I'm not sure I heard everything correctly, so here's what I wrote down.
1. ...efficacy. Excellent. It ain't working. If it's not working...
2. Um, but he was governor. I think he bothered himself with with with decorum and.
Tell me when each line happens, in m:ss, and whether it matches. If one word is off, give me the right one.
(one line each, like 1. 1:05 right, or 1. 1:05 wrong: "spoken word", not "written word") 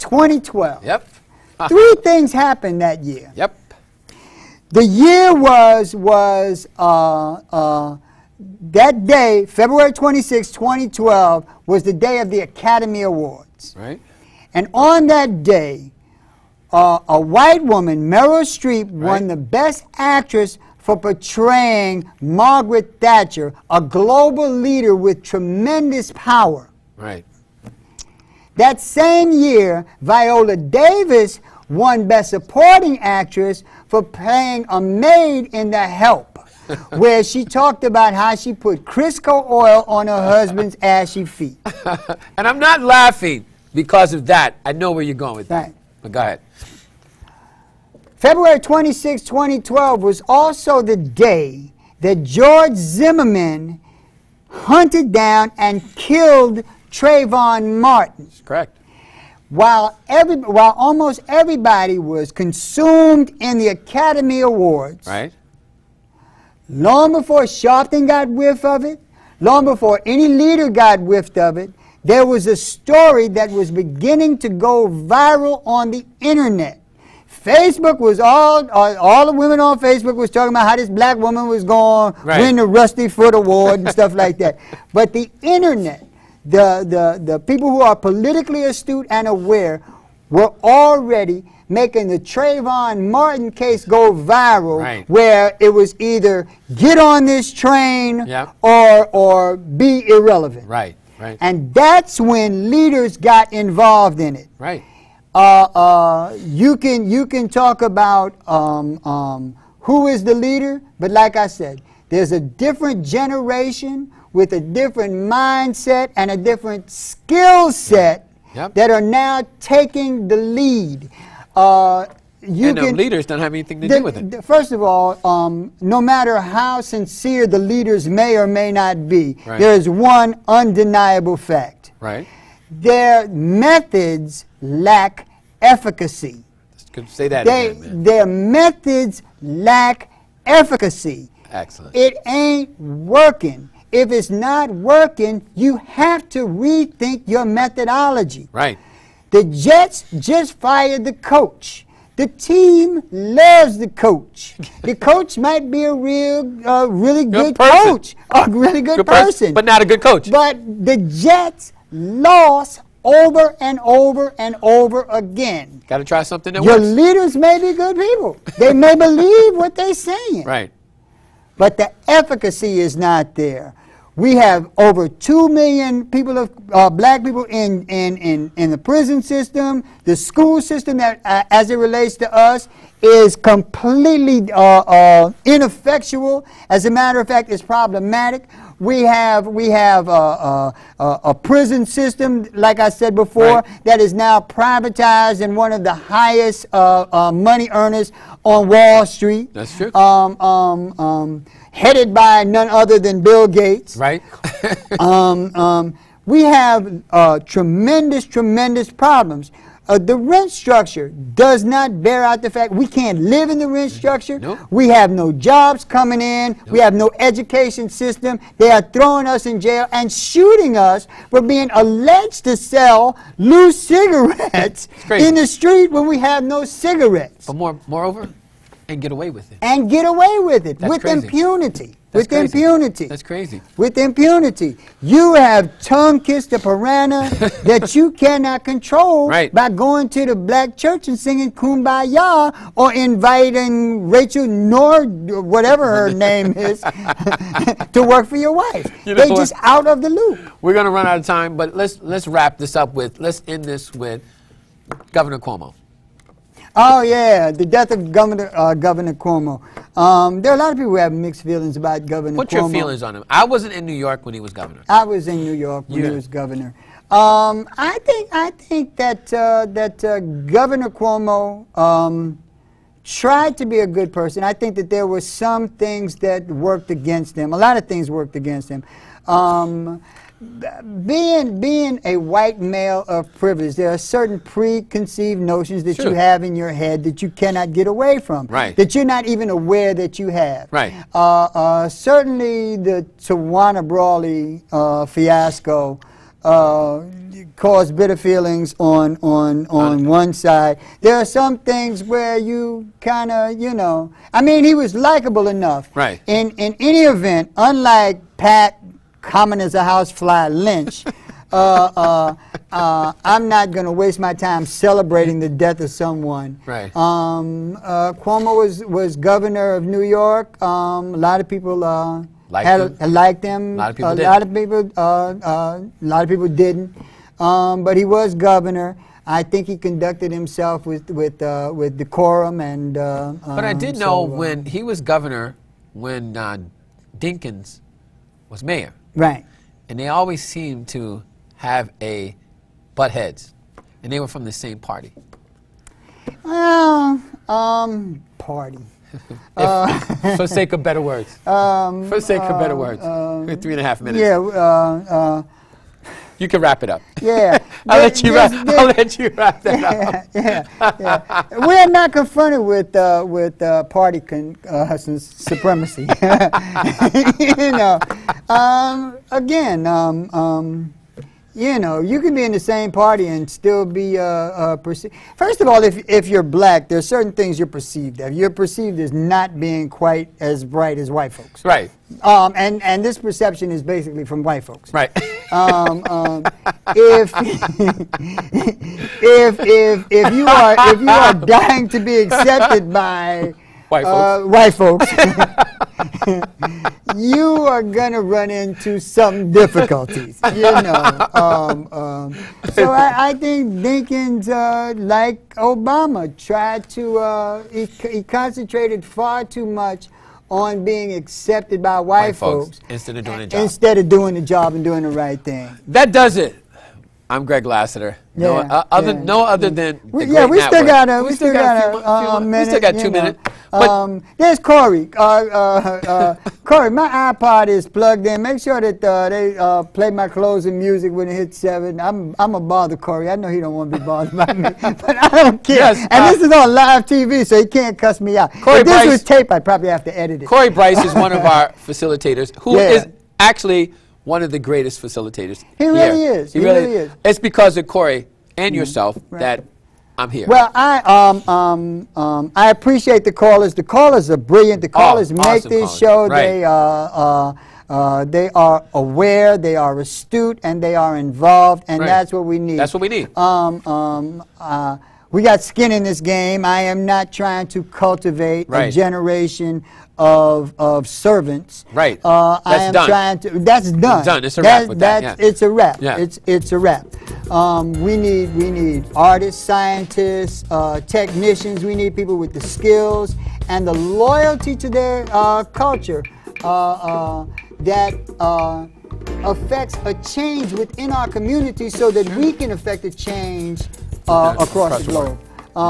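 1. 2:20 right
2. 5:27 wrong: "conducted", not "bothered".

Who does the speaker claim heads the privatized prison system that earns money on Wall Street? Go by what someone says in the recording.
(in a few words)
Bill Gates.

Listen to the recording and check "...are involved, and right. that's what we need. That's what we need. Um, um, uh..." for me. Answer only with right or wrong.
right.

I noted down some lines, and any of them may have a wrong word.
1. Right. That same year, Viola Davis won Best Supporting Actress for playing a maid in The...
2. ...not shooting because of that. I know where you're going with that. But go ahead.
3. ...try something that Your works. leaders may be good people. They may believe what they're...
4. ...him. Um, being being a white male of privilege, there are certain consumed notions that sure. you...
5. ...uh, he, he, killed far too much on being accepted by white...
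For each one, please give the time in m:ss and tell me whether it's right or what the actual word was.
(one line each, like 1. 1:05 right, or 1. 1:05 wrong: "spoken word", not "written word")
1. 0:26 right
2. 0:42 wrong: "laughing", not "shooting"
3. 2:46 right
4. 4:38 wrong: "preconceived", not "consumed"
5. 6:47 wrong: "concentrated", not "killed".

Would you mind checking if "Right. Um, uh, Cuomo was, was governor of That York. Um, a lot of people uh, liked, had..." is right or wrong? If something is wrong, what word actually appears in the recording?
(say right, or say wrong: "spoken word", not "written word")
wrong: "New", not "That".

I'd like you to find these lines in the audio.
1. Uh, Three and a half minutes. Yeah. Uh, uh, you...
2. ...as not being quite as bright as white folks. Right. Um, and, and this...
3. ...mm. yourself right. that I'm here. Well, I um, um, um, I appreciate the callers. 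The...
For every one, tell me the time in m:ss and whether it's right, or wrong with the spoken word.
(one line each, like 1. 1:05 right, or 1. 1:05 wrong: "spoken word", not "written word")
1. 5:53 right
2. 6:18 right
3. 7:28 right.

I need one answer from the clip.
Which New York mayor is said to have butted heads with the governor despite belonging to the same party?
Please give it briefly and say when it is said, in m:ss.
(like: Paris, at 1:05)
Dinkins, at 5:37.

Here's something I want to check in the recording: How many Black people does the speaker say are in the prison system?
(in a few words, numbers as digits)
Over 2 million.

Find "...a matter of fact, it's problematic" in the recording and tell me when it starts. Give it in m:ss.
3:06.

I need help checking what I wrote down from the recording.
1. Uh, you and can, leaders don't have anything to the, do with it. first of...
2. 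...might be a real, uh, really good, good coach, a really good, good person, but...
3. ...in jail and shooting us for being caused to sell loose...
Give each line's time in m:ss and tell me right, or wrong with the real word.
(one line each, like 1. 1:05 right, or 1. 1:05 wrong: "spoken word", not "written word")
1. 2:01 right
2. 2:35 right
3. 3:39 wrong: "alleged", not "caused".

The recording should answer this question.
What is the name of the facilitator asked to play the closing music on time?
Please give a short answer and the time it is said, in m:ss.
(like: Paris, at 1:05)
Corey Bryce, at 7:20.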